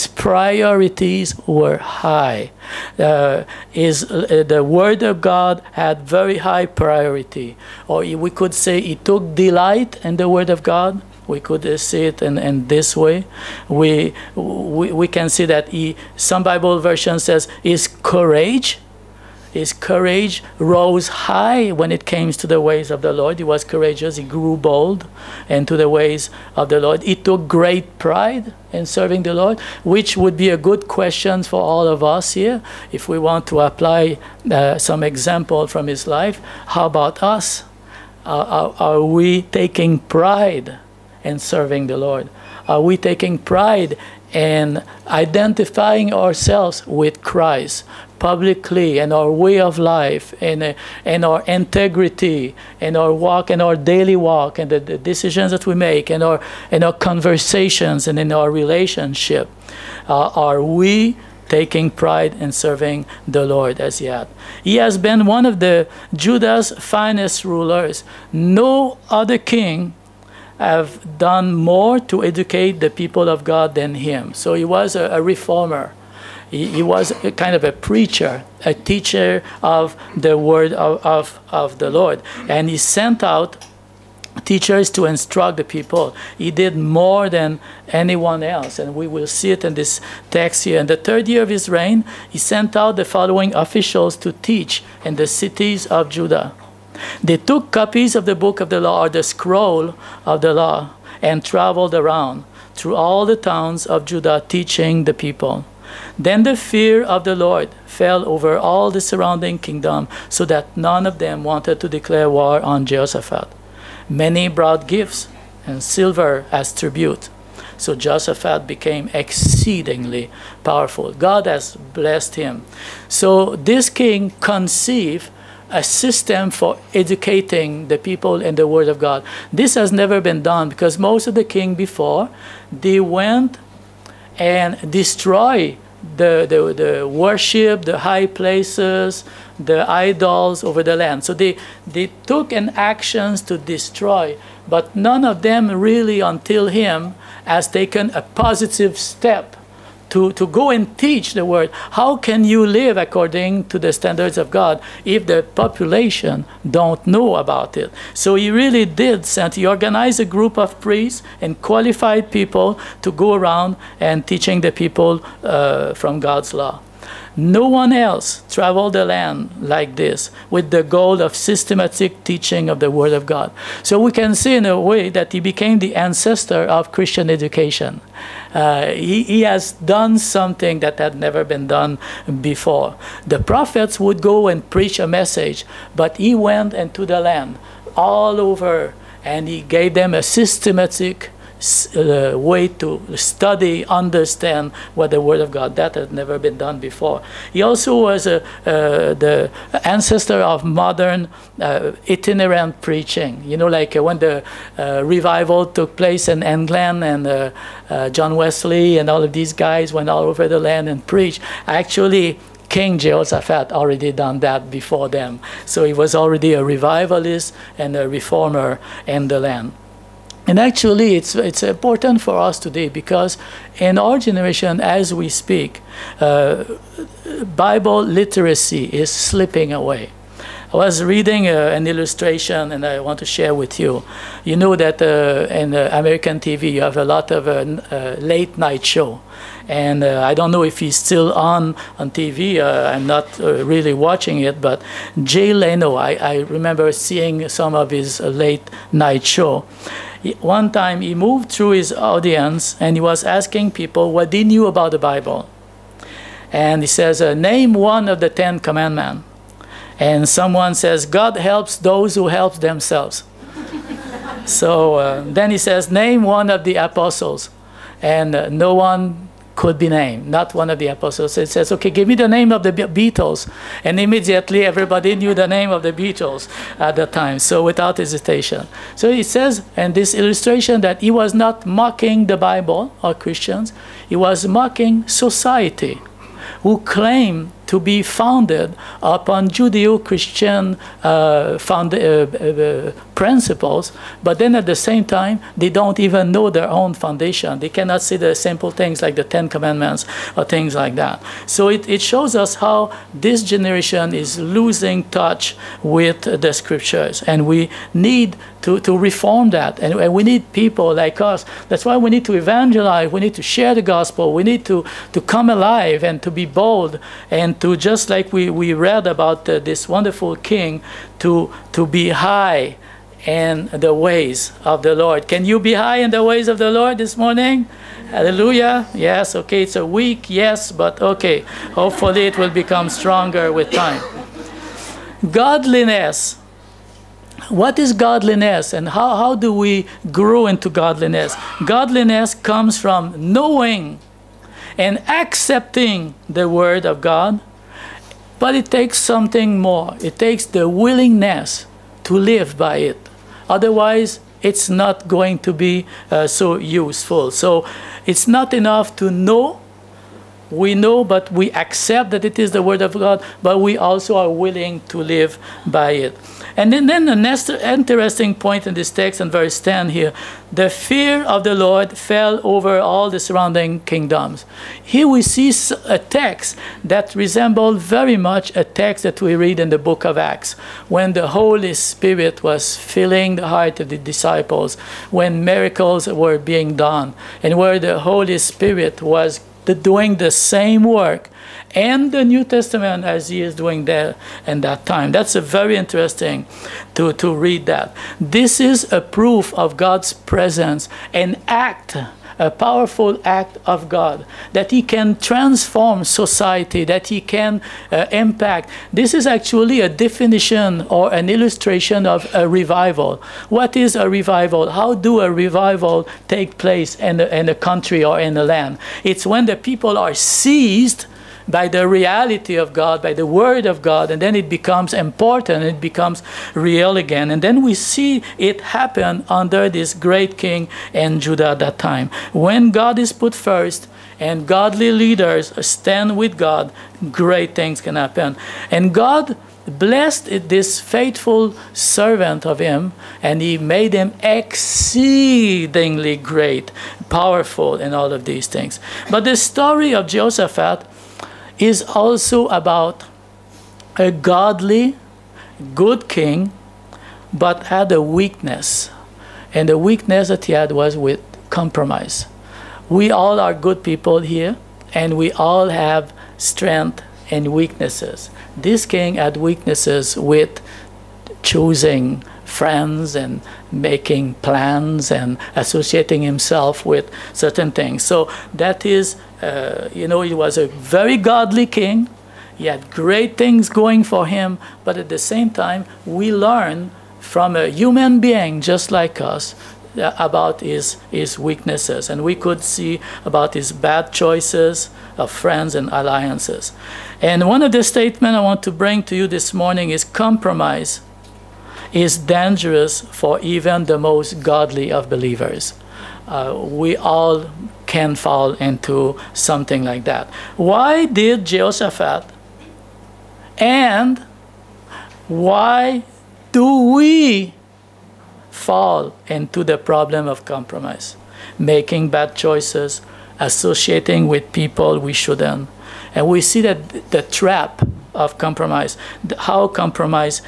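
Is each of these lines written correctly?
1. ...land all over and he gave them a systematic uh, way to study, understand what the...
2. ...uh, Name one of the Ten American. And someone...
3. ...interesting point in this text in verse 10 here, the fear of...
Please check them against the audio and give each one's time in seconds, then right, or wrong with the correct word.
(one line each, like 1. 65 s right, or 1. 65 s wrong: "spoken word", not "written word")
1. 187 s right
2. 257 s wrong: "Commandments", not "American"
3. 367 s right.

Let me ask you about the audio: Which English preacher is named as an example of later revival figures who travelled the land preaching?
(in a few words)
John Wesley.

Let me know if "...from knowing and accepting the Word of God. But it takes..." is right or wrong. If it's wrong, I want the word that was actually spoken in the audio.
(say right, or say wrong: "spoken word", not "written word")
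right.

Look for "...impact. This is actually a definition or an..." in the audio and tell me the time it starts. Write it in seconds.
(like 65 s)
408 s.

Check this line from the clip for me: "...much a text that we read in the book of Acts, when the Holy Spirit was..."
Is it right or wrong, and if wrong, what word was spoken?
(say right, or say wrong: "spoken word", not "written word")
right.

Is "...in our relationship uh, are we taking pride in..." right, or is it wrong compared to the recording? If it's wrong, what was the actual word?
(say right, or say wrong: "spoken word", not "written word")
right.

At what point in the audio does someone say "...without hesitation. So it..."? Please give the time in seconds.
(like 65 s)
277 s.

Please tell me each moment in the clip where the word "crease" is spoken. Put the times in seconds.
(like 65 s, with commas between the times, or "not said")
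not said.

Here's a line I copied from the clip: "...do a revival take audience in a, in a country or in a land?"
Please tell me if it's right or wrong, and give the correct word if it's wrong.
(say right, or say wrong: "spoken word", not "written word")
wrong: "place", not "audience".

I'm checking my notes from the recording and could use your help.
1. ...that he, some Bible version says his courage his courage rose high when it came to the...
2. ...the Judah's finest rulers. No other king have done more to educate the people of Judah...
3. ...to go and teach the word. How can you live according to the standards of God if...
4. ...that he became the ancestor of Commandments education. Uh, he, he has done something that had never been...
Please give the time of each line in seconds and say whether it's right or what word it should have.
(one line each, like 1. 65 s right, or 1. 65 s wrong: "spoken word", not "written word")
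1. 15 s right
2. 65 s wrong: "God", not "Judah"
3. 150 s right
4. 175 s wrong: "Christian", not "Commandments".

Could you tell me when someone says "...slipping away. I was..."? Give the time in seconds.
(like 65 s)
229 s.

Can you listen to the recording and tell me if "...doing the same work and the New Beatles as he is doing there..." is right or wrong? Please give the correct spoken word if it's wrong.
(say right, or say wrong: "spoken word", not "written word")
wrong: "Testament", not "Beatles".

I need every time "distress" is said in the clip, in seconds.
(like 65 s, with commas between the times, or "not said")
not said.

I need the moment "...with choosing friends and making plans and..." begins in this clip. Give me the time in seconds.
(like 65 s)
470 s.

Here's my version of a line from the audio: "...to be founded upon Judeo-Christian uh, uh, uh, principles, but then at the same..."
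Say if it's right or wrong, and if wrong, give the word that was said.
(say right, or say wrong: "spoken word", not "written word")
right.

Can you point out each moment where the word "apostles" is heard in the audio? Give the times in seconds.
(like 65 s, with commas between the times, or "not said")
266 s, 270 s.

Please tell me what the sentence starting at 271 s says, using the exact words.
It says, okay, give me the name of the Beatles.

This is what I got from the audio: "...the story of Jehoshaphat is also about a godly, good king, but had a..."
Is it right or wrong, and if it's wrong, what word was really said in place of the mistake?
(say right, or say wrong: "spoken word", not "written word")
right.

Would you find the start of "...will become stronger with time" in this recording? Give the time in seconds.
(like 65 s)
332 s.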